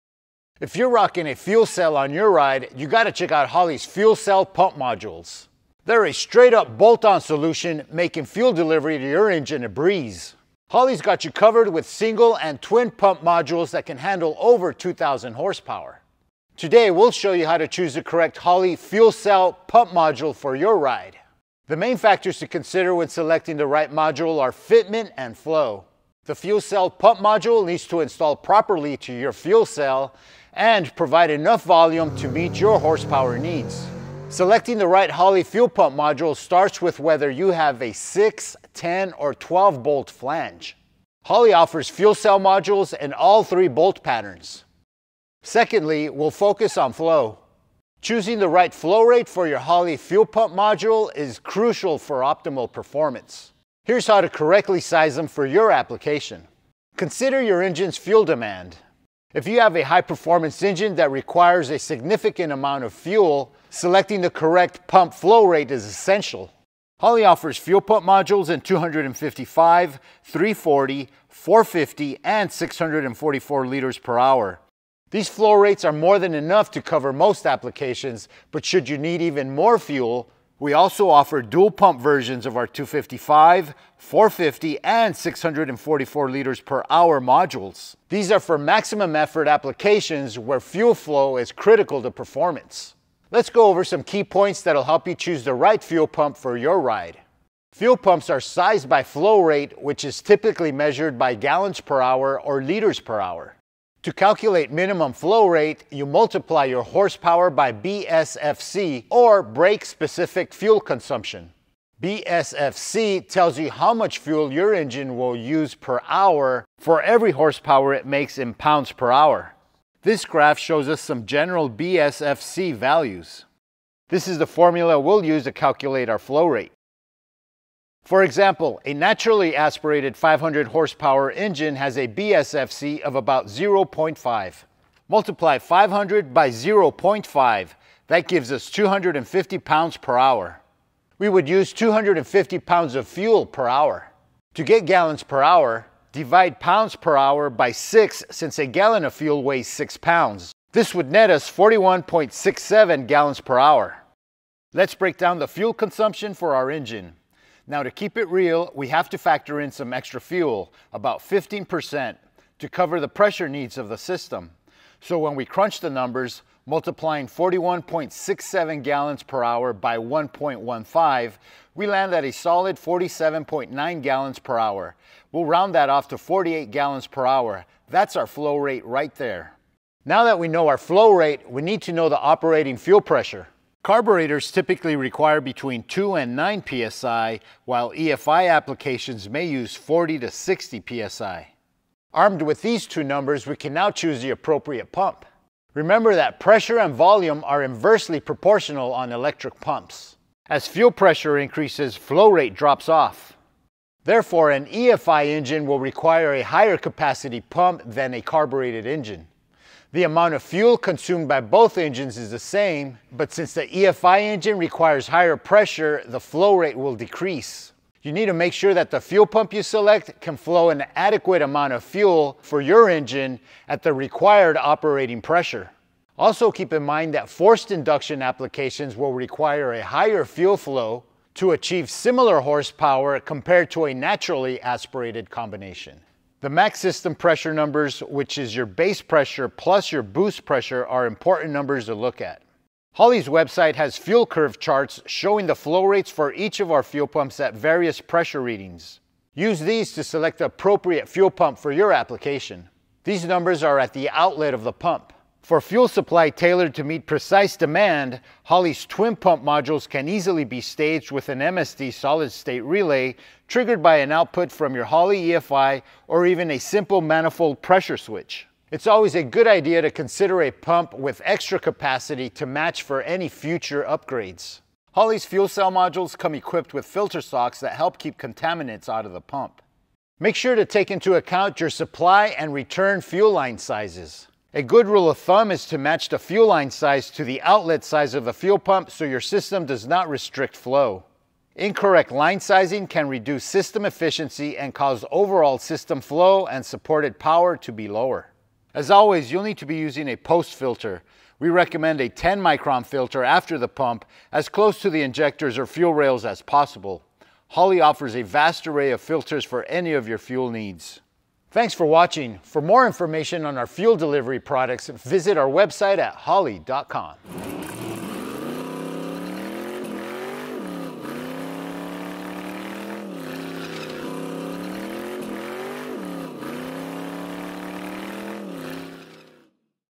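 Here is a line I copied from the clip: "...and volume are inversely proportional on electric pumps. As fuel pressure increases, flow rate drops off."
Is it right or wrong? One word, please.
right.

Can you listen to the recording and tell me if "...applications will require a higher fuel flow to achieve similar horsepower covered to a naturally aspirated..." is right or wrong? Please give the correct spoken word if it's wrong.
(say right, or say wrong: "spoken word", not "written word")
wrong: "compared", not "covered".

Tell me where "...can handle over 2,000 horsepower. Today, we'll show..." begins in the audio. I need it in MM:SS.
00:13.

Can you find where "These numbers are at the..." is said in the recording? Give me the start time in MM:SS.
04:13.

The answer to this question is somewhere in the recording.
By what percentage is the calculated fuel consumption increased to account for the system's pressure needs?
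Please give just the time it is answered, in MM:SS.
02:41.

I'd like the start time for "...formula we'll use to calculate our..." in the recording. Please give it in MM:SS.
02:04.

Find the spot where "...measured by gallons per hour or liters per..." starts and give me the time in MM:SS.
01:40.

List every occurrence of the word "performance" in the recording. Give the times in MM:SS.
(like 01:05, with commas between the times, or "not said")
00:52, 01:00, 01:32.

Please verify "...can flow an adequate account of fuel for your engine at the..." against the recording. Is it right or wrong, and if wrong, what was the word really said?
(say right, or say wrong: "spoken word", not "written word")
wrong: "amount", not "account".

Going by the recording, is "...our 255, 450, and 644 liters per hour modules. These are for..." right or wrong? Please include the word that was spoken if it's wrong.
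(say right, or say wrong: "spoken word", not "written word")
right.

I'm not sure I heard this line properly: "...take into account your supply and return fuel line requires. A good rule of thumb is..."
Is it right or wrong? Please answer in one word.
wrong.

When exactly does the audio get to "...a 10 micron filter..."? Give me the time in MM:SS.
05:02.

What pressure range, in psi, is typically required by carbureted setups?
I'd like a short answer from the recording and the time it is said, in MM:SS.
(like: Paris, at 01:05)
2 to 9 psi, at 03:05.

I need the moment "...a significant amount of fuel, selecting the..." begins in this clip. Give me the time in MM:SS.
01:01.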